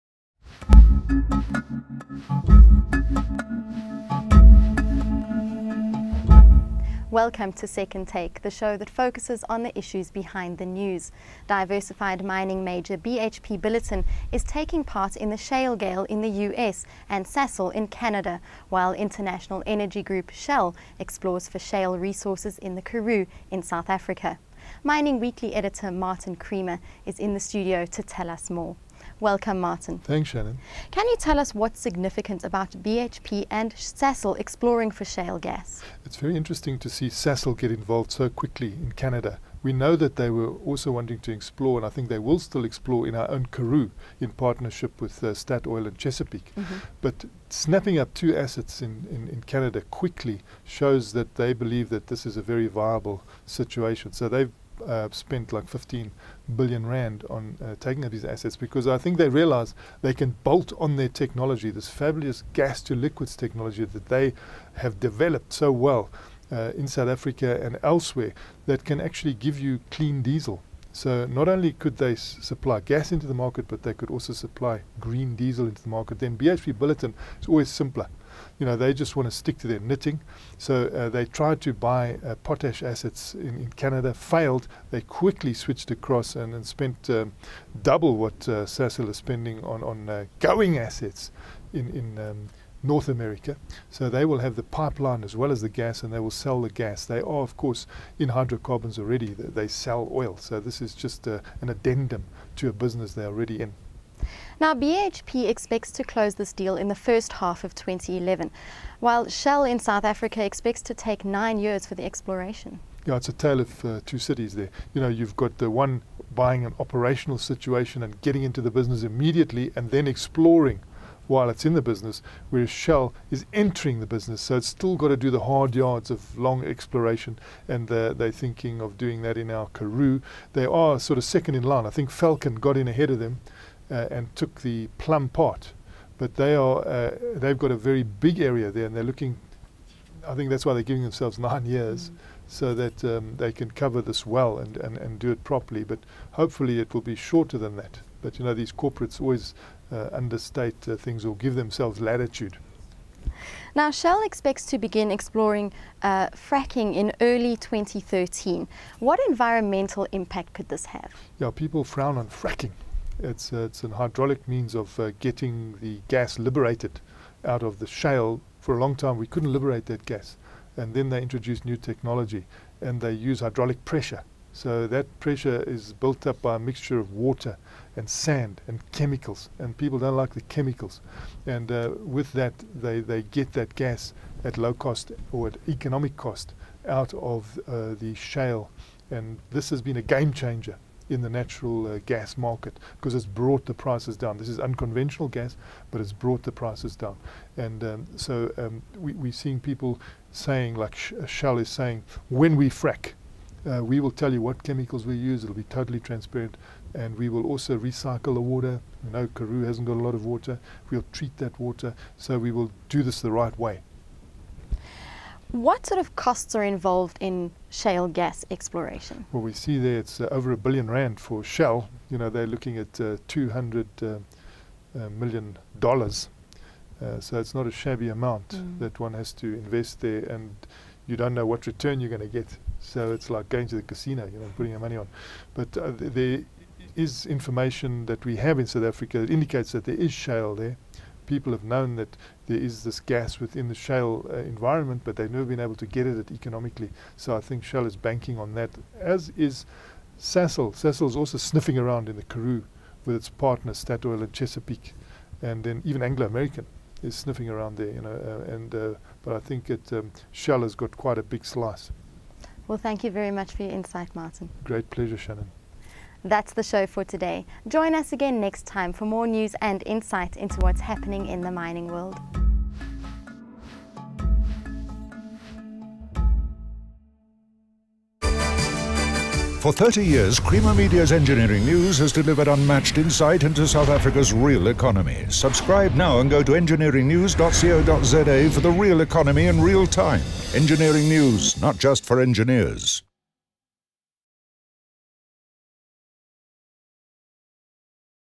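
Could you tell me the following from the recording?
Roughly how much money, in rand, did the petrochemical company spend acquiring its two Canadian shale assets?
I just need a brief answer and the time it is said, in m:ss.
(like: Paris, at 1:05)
15 billion rand, at 0:55.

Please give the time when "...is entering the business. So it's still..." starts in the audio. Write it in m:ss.
2:03.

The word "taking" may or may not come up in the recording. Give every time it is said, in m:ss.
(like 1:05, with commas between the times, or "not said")
0:14, 0:57.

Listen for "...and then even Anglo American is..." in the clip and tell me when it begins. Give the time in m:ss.
4:15.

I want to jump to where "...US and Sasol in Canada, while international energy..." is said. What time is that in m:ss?
0:16.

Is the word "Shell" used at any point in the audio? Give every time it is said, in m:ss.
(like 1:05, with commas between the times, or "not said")
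0:20, 1:49, 2:02, 2:33, 3:21, 3:41, 4:07, 4:20.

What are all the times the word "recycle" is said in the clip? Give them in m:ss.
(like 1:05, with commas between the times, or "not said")
3:27.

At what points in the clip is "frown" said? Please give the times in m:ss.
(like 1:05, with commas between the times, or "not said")
2:41.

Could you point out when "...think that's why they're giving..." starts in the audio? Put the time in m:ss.
2:20.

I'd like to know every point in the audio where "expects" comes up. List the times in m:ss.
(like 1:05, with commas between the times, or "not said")
1:45, 1:50, 2:34.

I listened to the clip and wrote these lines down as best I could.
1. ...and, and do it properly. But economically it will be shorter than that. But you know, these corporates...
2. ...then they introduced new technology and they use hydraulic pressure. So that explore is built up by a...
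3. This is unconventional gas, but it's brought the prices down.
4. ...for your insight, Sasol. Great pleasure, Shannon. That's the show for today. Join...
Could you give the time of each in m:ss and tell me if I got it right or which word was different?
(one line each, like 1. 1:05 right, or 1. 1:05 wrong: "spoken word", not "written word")
1. 2:24 wrong: "hopefully", not "economically"
2. 2:50 wrong: "pressure", not "explore"
3. 3:14 right
4. 4:23 wrong: "Martin", not "Sasol".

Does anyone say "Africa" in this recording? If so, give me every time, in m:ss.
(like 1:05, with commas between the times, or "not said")
0:23, 1:07, 1:50, 3:58, 4:43.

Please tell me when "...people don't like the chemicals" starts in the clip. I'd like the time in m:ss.
2:59.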